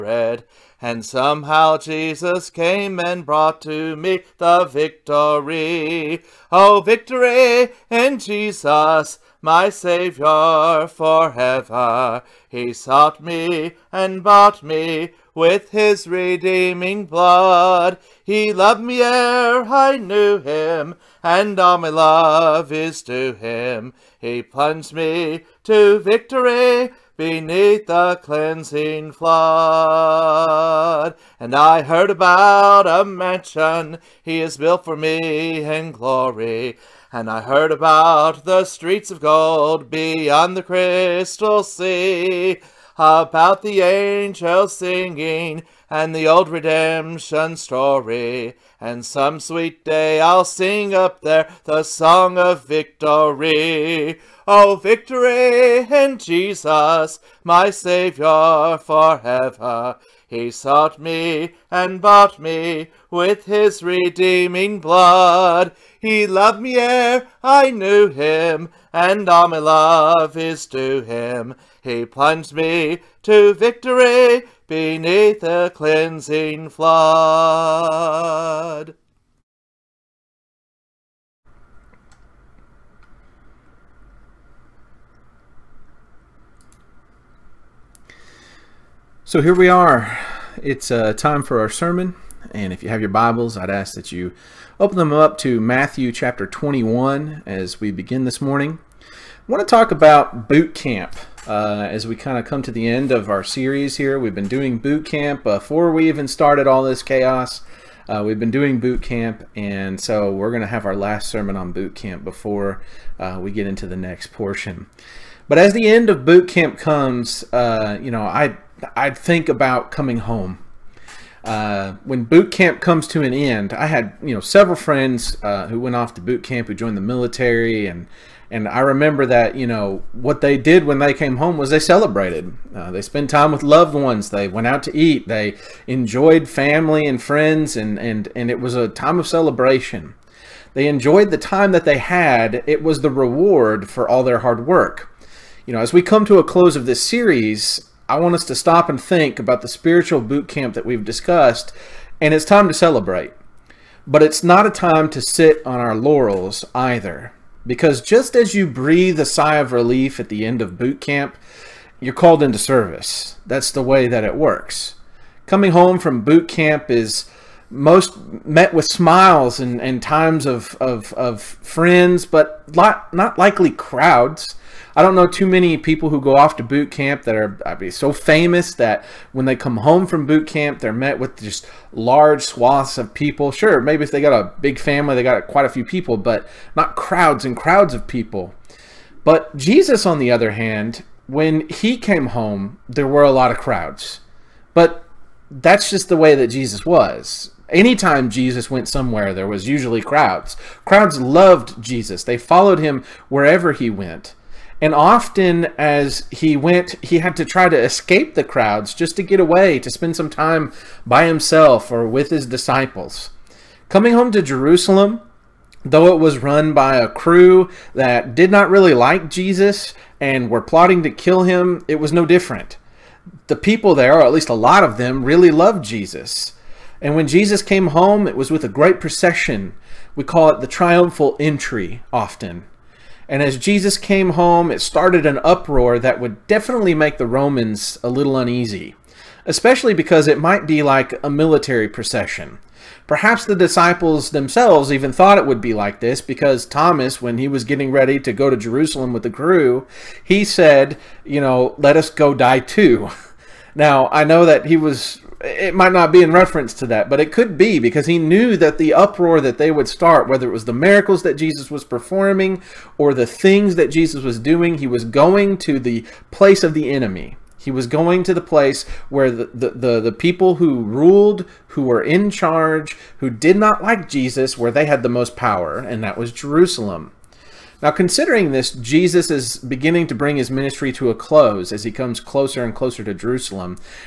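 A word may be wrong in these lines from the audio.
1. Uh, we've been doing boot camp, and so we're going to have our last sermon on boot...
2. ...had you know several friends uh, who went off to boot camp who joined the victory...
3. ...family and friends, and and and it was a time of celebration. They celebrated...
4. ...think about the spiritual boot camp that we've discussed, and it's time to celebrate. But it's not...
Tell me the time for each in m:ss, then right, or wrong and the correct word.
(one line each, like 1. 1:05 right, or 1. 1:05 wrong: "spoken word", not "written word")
1. 1:48 right
2. 2:03 wrong: "military", not "victory"
3. 2:16 wrong: "enjoyed", not "celebrated"
4. 2:29 right.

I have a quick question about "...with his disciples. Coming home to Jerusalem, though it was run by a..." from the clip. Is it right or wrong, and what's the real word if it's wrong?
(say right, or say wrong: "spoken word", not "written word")
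right.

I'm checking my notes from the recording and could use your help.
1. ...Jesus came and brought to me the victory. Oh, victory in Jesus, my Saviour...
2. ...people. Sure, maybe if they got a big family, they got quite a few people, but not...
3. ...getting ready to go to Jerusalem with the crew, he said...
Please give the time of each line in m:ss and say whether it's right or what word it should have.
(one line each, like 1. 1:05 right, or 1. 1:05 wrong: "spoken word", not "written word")
1. 0:01 right
2. 3:03 right
3. 4:07 right.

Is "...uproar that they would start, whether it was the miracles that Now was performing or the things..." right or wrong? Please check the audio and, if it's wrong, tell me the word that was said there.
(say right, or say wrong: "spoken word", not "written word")
wrong: "Jesus", not "Now".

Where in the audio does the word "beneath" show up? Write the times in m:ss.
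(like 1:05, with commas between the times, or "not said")
0:27, 1:14.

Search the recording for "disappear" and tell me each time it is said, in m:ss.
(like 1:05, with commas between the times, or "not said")
not said.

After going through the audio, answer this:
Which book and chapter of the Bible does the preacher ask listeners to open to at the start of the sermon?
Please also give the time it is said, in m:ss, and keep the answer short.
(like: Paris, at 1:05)
Matthew 21, at 1:35.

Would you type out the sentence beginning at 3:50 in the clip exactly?
We call it the triumphal entry often.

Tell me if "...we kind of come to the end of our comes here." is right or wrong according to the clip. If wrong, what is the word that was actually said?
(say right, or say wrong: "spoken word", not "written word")
wrong: "series", not "comes".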